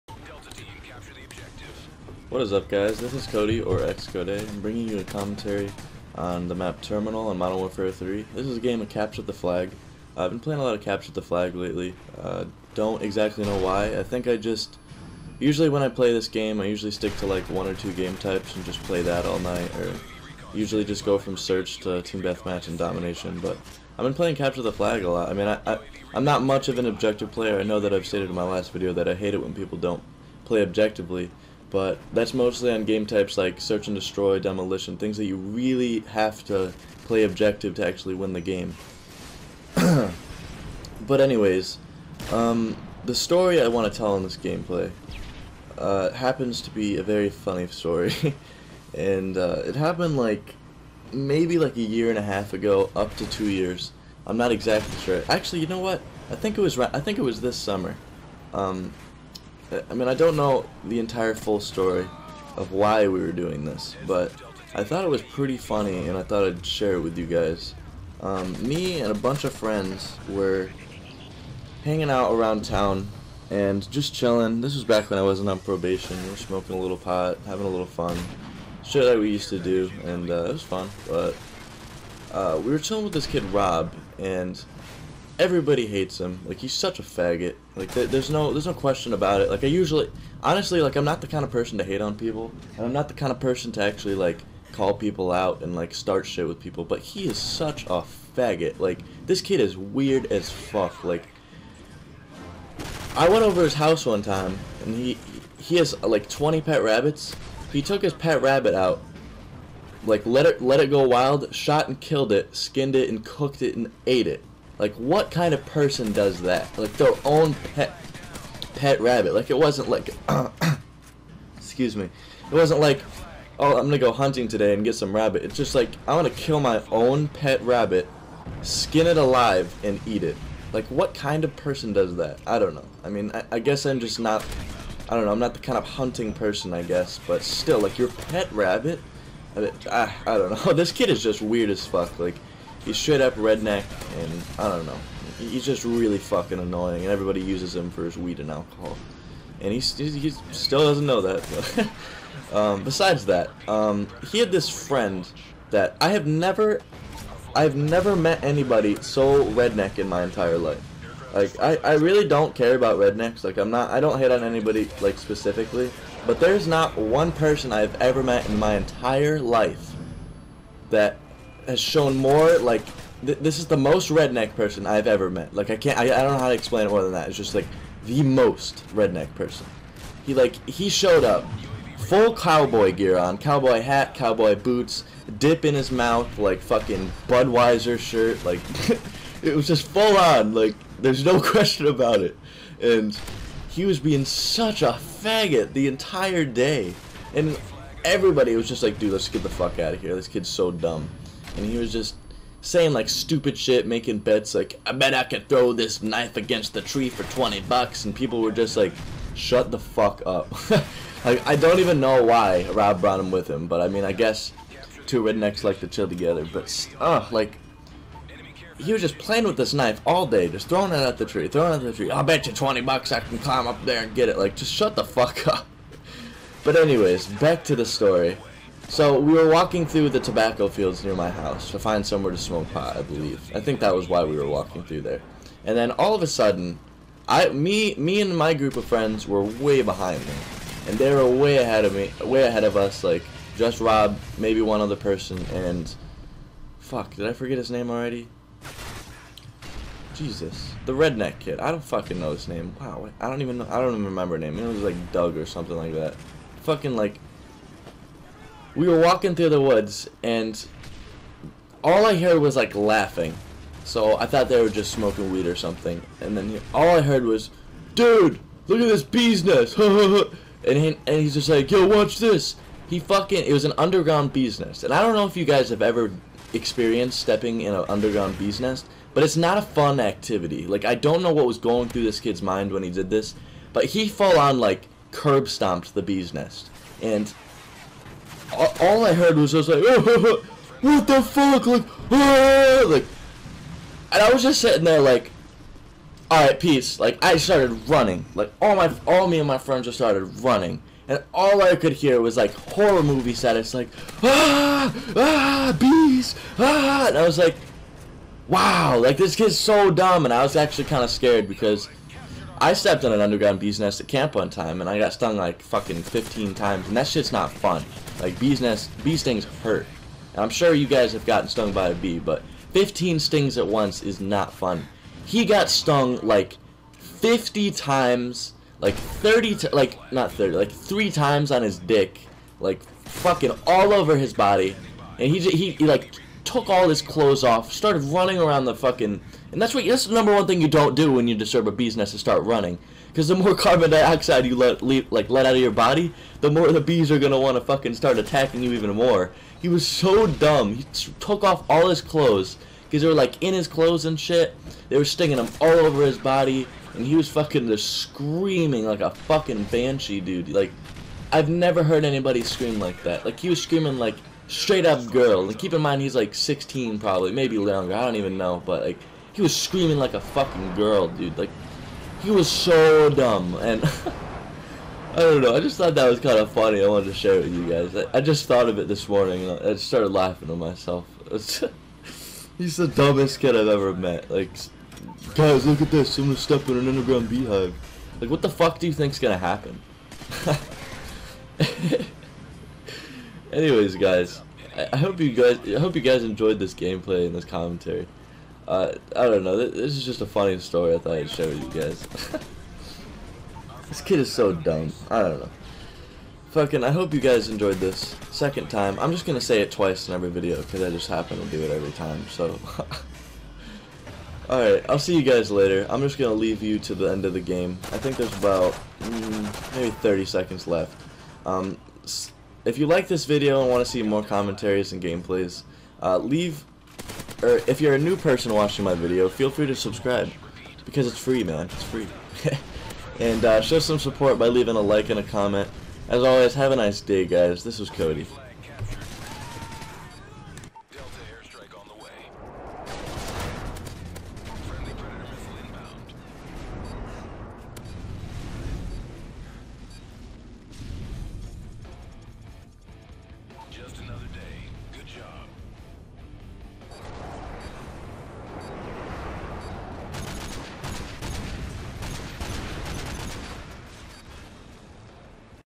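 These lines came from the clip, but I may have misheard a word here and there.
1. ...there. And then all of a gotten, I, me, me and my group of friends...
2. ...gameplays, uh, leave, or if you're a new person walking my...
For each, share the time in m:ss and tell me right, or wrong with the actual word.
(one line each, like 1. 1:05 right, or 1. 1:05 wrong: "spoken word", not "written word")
1. 3:55 wrong: "sudden", not "gotten"
2. 7:05 wrong: "watching", not "walking".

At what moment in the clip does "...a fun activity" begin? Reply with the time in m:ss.
4:39.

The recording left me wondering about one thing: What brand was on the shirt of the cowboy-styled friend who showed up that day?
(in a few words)
Budweiser.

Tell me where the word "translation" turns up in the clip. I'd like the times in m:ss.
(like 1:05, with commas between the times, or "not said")
not said.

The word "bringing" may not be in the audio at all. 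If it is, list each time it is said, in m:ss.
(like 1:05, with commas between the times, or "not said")
0:04.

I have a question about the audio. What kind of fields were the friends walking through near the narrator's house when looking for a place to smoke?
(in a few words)
Tobacco fields.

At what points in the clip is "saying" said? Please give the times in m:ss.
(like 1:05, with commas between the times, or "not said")
3:22.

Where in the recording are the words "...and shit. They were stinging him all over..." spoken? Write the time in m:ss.
5:54.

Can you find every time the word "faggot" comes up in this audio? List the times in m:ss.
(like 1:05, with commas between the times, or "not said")
1:27, 1:38, 3:15.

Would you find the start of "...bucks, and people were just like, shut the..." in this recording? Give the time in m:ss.
3:27.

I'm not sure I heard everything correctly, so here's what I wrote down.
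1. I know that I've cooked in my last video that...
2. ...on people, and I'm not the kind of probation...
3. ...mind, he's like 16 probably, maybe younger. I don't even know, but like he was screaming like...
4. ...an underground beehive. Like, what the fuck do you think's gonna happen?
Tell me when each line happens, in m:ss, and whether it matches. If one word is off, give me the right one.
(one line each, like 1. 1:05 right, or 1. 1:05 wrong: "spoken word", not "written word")
1. 0:27 wrong: "stated", not "cooked"
2. 1:32 wrong: "person", not "probation"
3. 6:05 right
4. 6:26 right.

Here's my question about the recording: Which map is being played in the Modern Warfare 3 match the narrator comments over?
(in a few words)
Terminal.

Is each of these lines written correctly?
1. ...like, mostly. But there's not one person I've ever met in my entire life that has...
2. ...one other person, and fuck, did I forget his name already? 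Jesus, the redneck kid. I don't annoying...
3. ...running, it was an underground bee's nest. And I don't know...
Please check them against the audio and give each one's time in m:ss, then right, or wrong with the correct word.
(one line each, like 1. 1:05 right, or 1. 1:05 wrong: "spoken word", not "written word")
1. 2:45 wrong: "specifically", not "mostly"
2. 4:04 wrong: "fucking", not "annoying"
3. 4:32 wrong: "fucking", not "running".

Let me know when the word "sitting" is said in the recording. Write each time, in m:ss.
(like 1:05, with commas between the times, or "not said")
4:54.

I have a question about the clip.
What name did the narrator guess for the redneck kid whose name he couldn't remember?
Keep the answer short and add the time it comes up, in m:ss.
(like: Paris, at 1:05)
Doug, at 4:15.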